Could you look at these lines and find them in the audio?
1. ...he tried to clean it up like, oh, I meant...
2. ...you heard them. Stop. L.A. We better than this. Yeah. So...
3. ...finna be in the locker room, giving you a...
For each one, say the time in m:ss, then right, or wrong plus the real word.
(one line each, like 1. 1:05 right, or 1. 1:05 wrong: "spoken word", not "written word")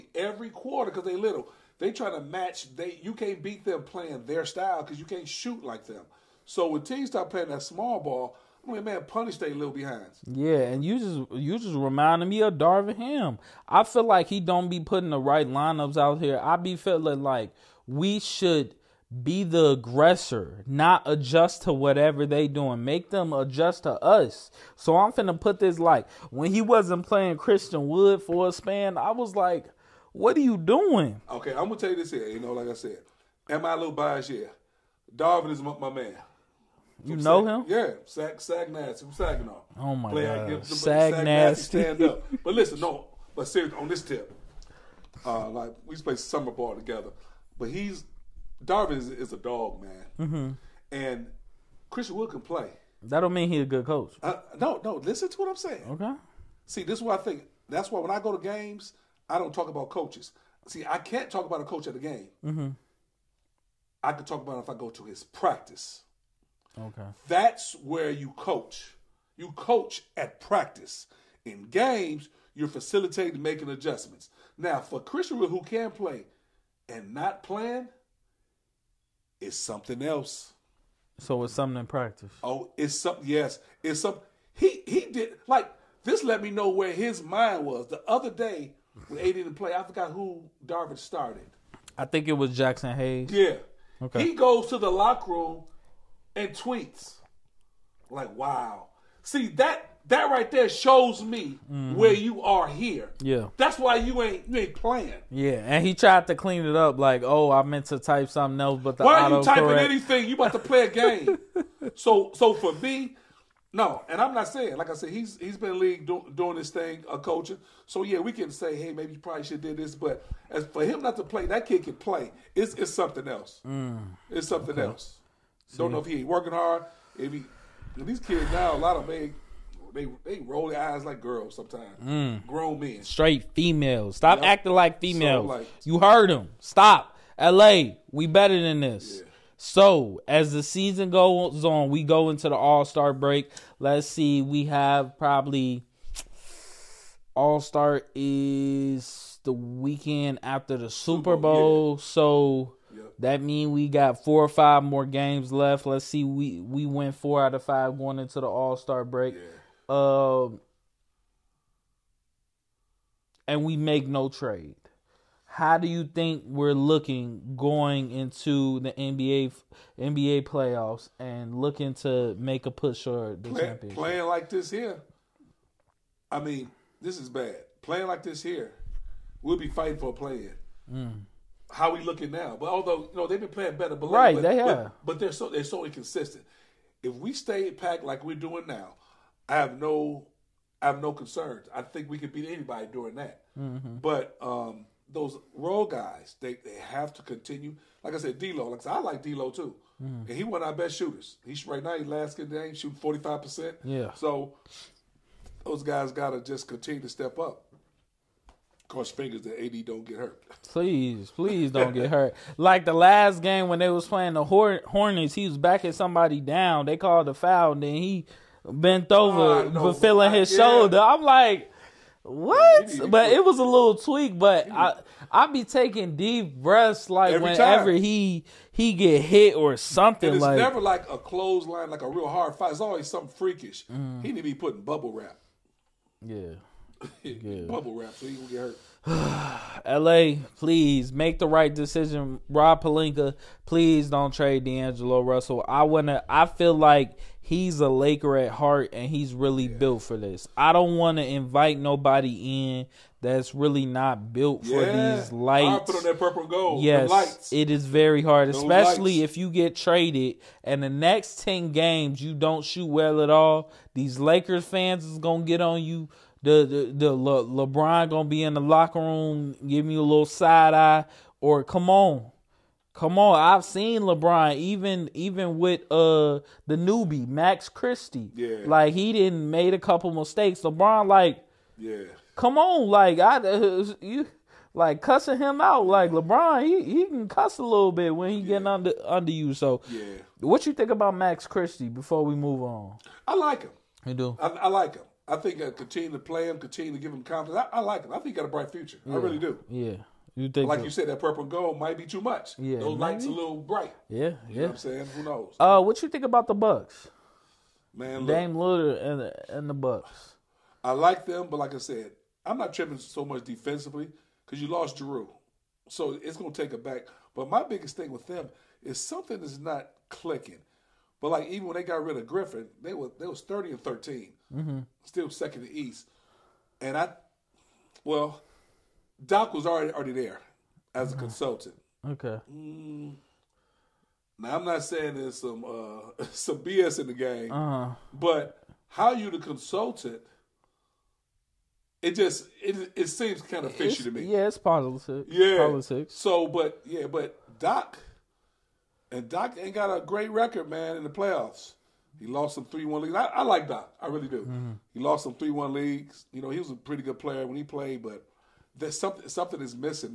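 1. 1:45 right
2. 2:15 right
3. 4:28 wrong: "gonna", not "finna".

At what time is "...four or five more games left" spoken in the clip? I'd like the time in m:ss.
2:34.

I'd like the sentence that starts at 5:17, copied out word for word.
But my biggest thing with them is something is not clicking.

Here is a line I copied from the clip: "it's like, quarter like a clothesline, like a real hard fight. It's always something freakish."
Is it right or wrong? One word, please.
wrong.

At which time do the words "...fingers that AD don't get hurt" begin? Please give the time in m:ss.
3:29.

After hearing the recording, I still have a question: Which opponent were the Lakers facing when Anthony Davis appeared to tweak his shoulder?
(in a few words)
Hornets.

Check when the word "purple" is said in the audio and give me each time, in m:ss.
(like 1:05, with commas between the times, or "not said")
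4:16, 5:01.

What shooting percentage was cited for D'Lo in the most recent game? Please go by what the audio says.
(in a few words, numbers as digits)
45.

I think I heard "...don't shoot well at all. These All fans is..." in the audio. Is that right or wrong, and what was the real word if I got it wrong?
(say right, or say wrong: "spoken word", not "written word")
wrong: "Lakers", not "All".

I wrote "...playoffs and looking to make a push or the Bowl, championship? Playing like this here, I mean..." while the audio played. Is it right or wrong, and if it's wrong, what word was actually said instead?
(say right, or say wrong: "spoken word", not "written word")
wrong: "Play", not "Bowl".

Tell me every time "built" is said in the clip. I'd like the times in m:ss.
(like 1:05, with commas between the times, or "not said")
4:09, 4:14.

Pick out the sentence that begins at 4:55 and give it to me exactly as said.
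I think I continue to play him, continue to give him confidence.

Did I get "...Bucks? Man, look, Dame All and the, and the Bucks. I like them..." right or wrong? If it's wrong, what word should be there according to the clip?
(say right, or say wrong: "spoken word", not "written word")
wrong: "Lillard", not "All".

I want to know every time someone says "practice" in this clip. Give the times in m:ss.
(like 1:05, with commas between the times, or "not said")
1:05, 1:10, 1:21.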